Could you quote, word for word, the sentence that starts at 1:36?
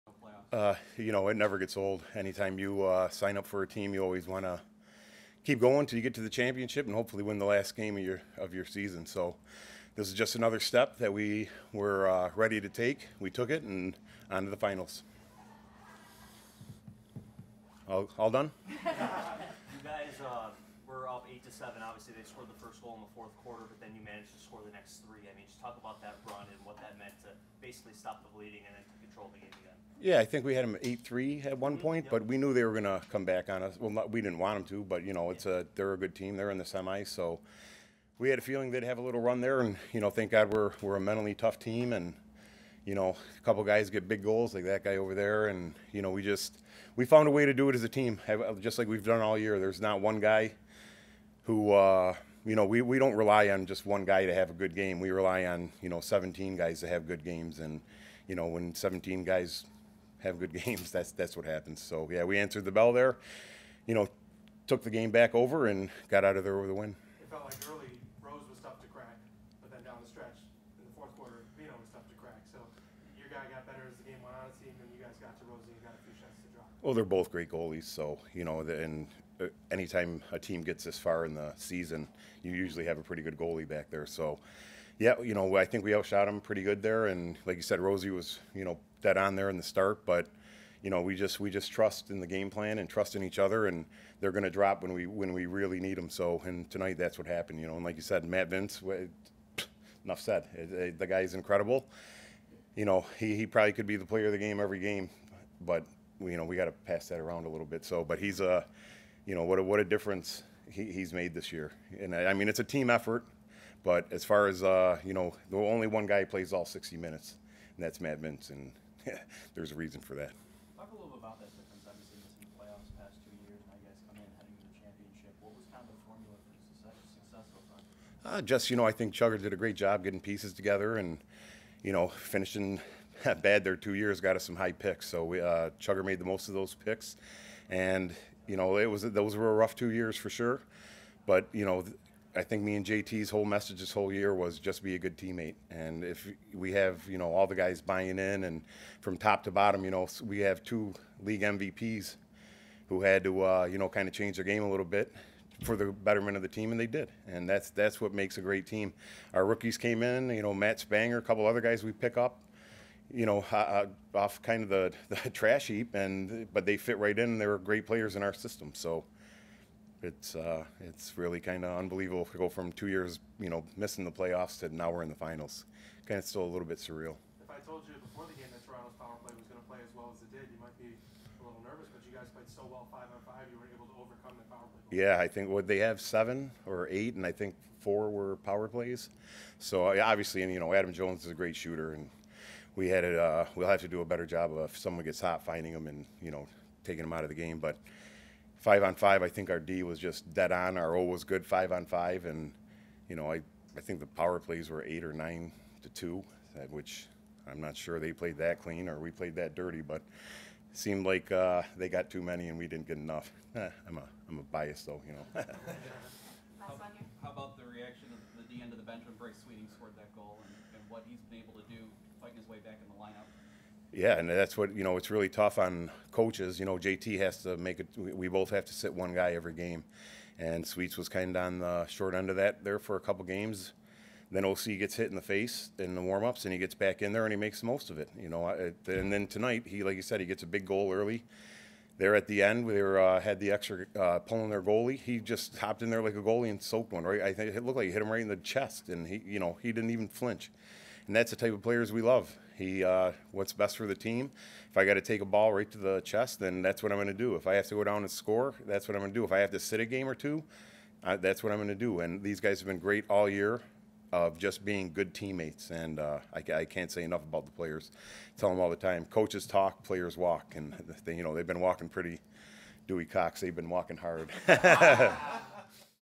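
So, and tonight that's what happened, you know.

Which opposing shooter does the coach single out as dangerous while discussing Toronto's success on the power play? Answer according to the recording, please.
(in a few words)
Adam Jones.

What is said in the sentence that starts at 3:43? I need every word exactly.
Yeah, and that's what you know.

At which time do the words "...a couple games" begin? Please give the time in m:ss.
3:52.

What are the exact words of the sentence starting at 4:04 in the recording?
He just hopped in there like a goalie and soaked one right.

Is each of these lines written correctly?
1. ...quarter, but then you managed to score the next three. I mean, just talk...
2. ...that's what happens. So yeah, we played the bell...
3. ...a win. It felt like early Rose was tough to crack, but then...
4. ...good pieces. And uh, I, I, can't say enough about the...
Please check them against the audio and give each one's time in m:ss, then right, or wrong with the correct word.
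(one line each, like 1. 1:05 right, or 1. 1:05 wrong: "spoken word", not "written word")
1. 0:23 right
2. 1:01 wrong: "answered", not "played"
3. 1:06 right
4. 4:24 wrong: "teammates", not "pieces".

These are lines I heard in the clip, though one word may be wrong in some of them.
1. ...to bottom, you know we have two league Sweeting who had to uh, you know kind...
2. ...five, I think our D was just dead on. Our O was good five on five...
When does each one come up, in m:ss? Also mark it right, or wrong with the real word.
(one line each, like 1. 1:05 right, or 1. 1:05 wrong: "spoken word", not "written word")
1. 2:29 wrong: "MVPs", not "Sweeting"
2. 3:18 right.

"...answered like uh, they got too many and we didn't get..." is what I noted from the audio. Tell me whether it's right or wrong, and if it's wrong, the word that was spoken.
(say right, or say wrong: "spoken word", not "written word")
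wrong: "seemed", not "answered".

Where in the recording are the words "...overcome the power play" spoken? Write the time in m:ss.
3:03.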